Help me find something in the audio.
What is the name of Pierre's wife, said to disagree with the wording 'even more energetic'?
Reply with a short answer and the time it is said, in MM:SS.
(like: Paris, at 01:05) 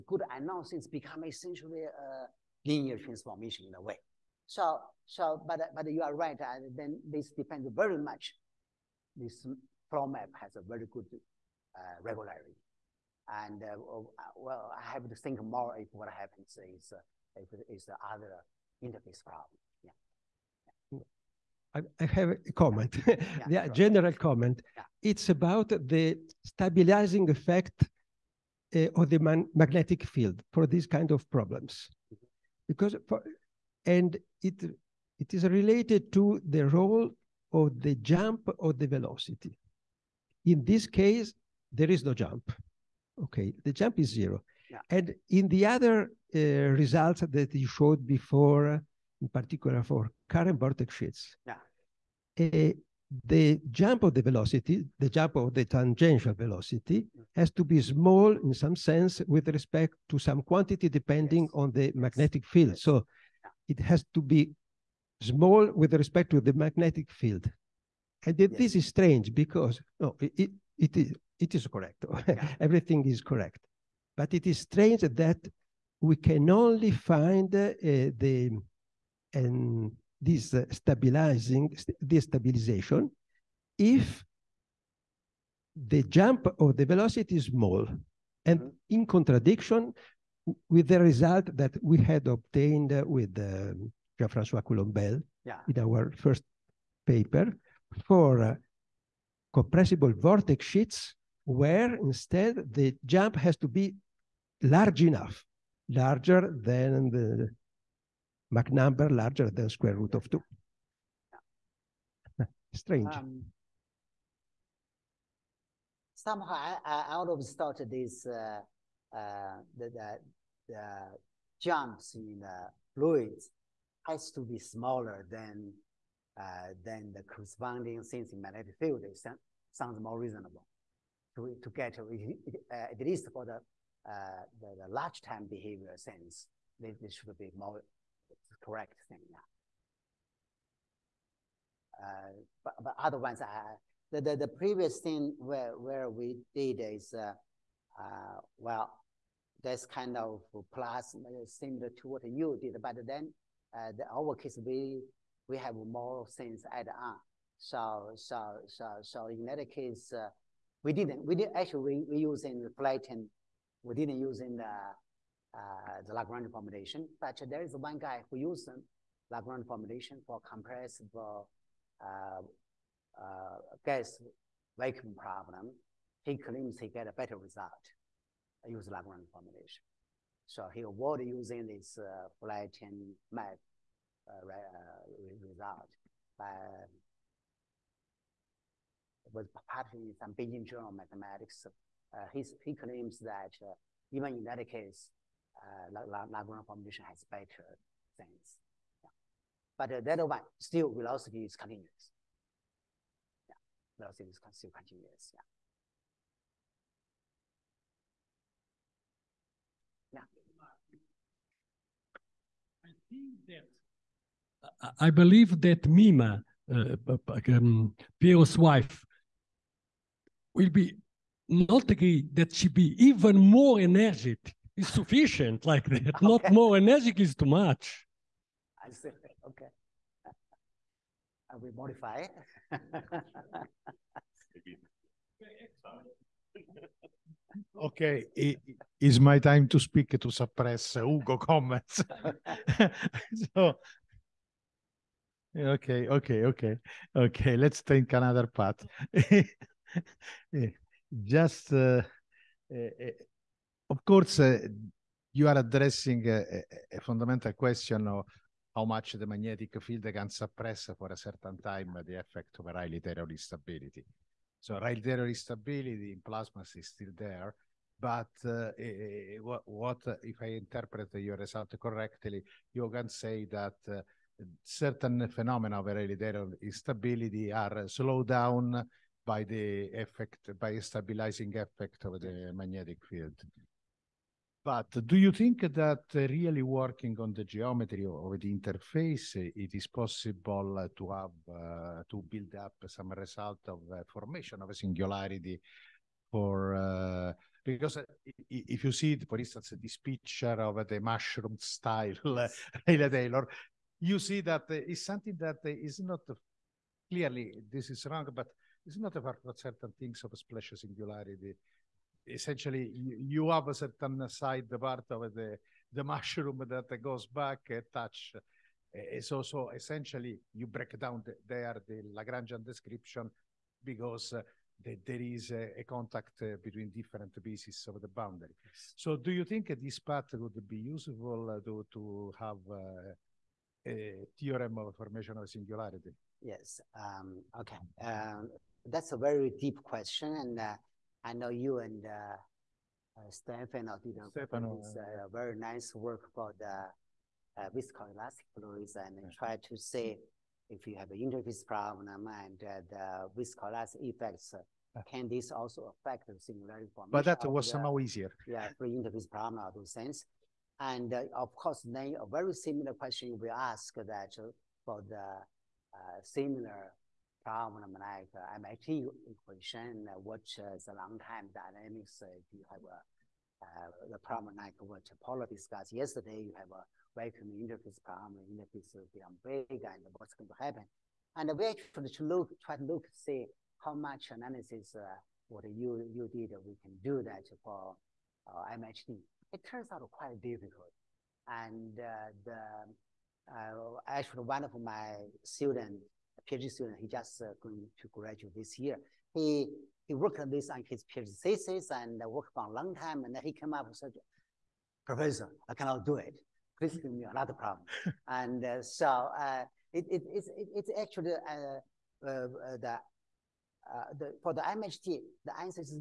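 Mima, at 03:35.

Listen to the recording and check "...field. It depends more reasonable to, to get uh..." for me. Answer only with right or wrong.
wrong.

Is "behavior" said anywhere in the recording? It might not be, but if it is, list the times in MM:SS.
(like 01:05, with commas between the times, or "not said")
02:15.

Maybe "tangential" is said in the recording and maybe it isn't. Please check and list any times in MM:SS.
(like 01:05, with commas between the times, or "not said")
00:55.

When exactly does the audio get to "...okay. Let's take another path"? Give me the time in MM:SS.
04:07.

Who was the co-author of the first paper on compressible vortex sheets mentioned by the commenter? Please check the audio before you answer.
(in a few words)
Jean-François Coulombel.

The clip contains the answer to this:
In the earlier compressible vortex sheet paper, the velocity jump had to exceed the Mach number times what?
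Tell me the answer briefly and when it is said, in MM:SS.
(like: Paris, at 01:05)
square root of 2, at 01:49.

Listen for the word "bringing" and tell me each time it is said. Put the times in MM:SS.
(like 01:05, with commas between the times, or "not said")
not said.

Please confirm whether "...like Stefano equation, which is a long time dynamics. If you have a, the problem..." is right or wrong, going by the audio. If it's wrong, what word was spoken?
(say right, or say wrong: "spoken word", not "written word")
wrong: "MHD", not "Stefano".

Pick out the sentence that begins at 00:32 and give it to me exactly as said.
because for, and it it is related to the role of the jump or the velocity.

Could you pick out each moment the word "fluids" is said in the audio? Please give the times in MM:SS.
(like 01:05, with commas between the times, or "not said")
02:02, 05:48.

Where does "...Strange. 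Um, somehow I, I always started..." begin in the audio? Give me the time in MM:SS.
01:52.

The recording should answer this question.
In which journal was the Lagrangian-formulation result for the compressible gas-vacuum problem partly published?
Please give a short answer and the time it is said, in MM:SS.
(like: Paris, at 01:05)
Beijing Journal mathematics, at 03:10.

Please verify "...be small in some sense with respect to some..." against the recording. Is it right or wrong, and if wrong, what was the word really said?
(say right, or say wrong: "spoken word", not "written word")
right.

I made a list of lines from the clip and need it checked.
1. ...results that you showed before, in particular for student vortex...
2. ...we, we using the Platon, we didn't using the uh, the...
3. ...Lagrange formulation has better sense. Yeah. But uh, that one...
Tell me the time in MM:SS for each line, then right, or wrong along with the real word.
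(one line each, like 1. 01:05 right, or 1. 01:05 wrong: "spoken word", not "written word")
1. 00:46 wrong: "current", not "student"
2. 02:41 right
3. 03:16 right.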